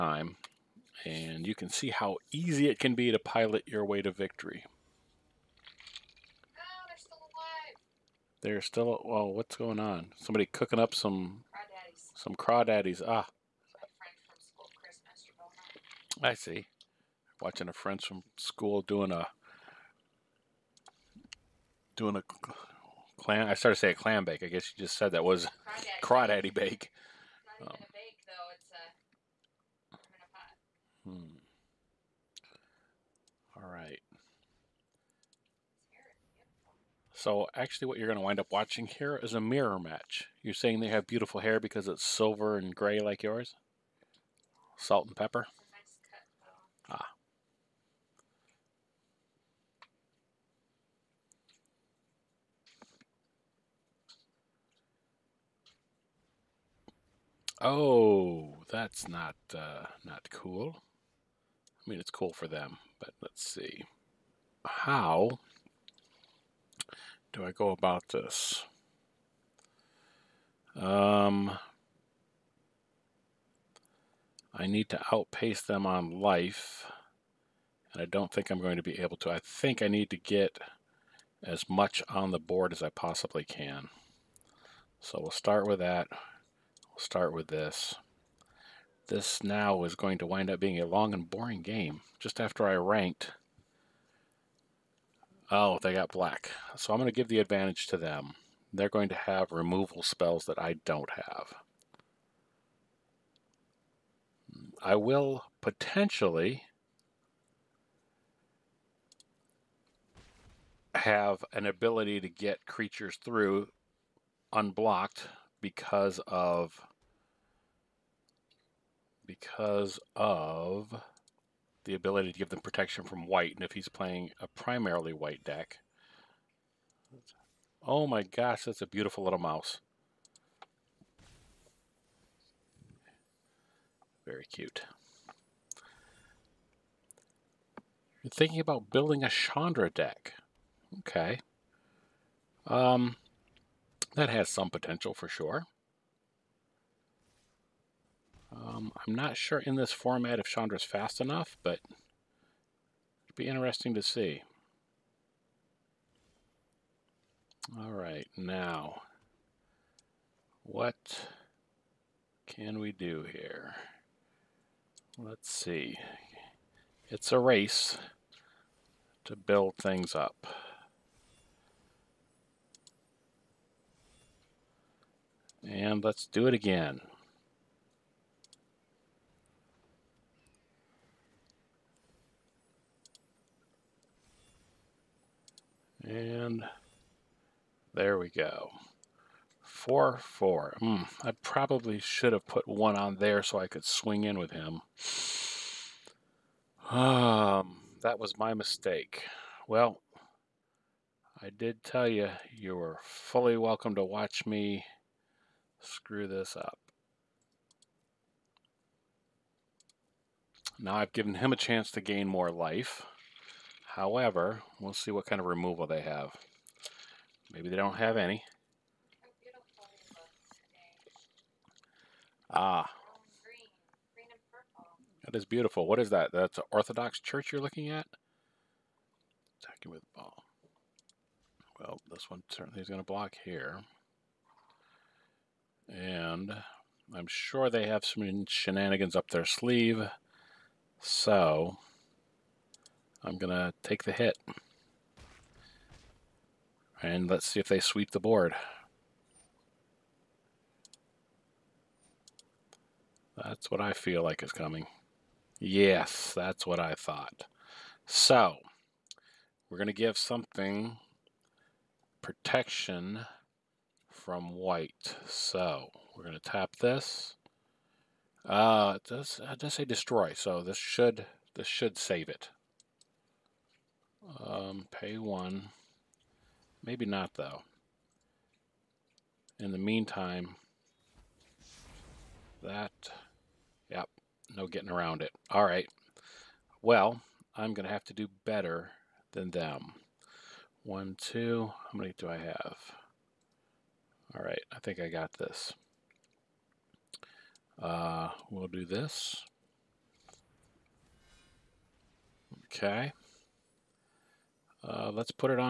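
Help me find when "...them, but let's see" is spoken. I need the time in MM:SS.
01:02.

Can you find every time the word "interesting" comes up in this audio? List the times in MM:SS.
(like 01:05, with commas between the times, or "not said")
02:33.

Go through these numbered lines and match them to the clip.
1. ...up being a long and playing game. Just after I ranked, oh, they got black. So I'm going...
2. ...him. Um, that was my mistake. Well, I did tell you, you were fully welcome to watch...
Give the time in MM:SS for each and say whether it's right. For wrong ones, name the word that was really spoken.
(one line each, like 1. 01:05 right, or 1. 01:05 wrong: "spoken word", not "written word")
1. 01:30 wrong: "boring", not "playing"
2. 03:14 right.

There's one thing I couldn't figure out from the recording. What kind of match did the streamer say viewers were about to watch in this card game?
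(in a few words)
Mirror match.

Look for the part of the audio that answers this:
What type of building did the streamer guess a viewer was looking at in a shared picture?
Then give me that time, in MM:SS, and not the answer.
03:46.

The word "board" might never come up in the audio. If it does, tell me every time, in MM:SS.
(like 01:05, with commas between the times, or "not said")
01:22, 04:08.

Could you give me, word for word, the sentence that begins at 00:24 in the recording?
I guess you just said that was crawdaddy, crawdaddy bake.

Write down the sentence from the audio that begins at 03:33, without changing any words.
However, we'll see what kind of removal they have.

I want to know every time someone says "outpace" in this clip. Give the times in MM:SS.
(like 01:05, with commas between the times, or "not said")
01:15.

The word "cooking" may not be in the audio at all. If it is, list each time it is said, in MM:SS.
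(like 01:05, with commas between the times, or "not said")
00:10.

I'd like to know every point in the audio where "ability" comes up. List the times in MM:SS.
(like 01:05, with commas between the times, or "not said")
01:51, 02:01.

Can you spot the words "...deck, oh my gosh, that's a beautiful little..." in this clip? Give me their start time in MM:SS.
02:05.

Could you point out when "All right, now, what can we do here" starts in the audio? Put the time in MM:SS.
02:37.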